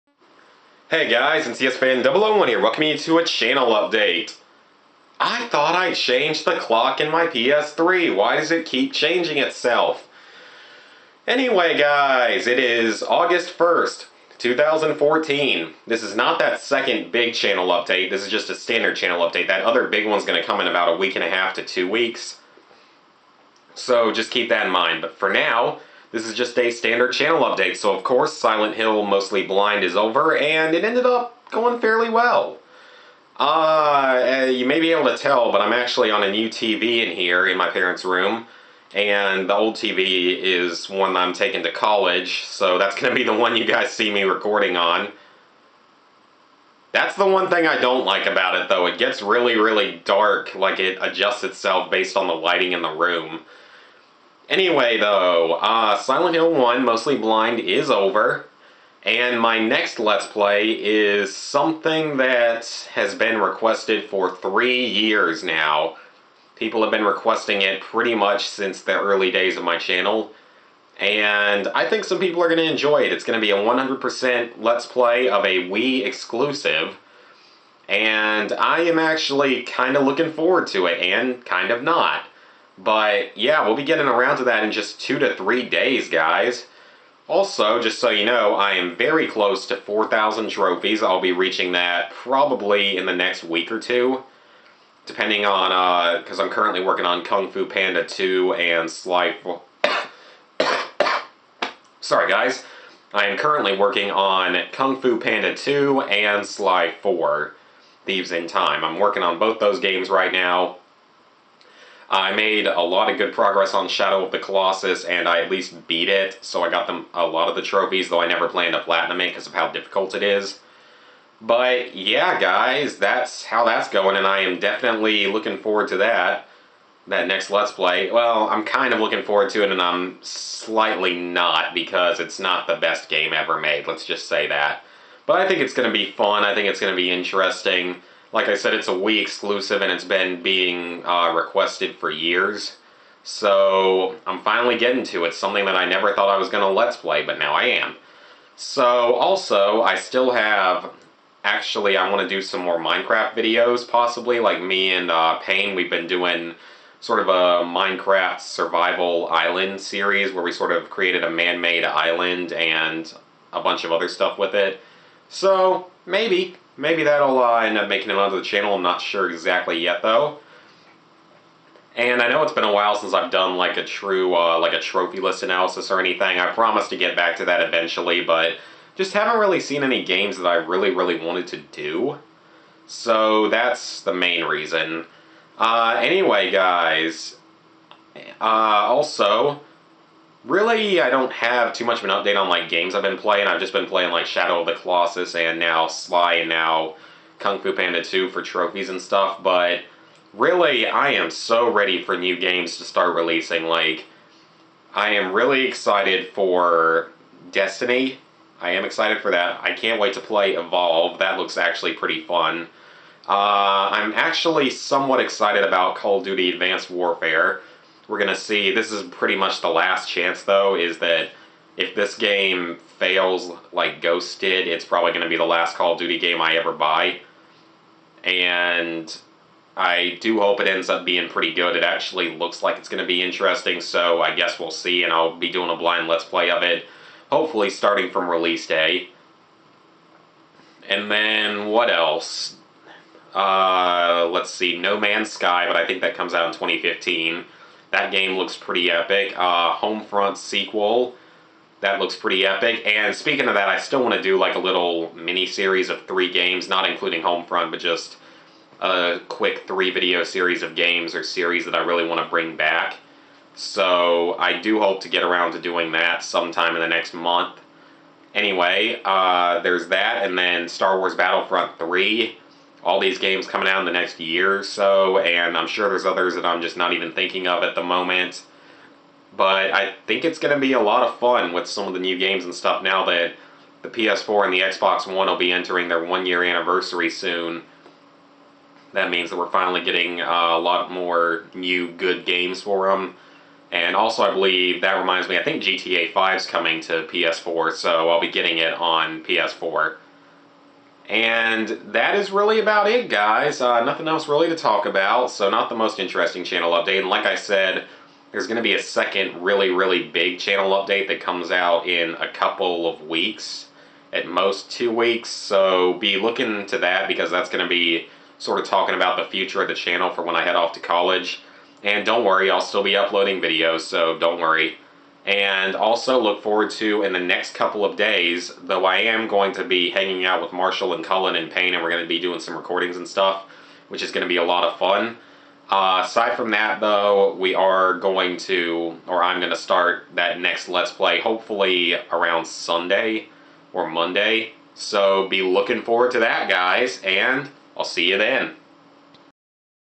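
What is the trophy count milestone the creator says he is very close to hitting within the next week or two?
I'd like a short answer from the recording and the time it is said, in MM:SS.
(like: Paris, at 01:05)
4,000, at 01:29.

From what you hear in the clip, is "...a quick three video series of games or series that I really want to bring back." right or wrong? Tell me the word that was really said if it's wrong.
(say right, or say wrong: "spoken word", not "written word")
right.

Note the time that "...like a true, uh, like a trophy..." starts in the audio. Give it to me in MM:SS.
02:53.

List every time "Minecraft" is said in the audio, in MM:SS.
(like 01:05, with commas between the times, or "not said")
02:32, 02:37.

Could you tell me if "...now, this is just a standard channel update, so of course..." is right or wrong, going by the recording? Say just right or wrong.
right.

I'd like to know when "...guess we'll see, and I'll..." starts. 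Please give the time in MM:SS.
03:54.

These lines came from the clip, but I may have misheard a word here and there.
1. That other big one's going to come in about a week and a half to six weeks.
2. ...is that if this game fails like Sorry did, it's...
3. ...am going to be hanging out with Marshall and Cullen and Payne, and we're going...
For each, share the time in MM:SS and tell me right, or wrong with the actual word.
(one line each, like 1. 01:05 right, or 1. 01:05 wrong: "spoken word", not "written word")
1. 00:19 wrong: "two", not "six"
2. 03:40 wrong: "Ghost", not "Sorry"
3. 05:28 right.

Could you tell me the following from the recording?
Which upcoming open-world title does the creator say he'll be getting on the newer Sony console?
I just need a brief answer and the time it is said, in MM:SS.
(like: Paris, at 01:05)
GTA 5, at 04:55.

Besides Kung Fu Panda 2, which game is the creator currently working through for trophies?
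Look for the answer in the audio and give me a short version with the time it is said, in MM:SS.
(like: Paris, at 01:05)
Sly 4, at 01:46.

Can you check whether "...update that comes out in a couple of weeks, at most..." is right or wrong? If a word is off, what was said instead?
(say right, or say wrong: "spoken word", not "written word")
right.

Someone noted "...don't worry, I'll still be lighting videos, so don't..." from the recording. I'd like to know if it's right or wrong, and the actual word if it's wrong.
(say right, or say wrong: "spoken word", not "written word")
wrong: "uploading", not "lighting".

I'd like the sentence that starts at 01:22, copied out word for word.
But yeah, we'll be getting around to that in just two to three days, guys.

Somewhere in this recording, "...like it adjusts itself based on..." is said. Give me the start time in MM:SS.
00:50.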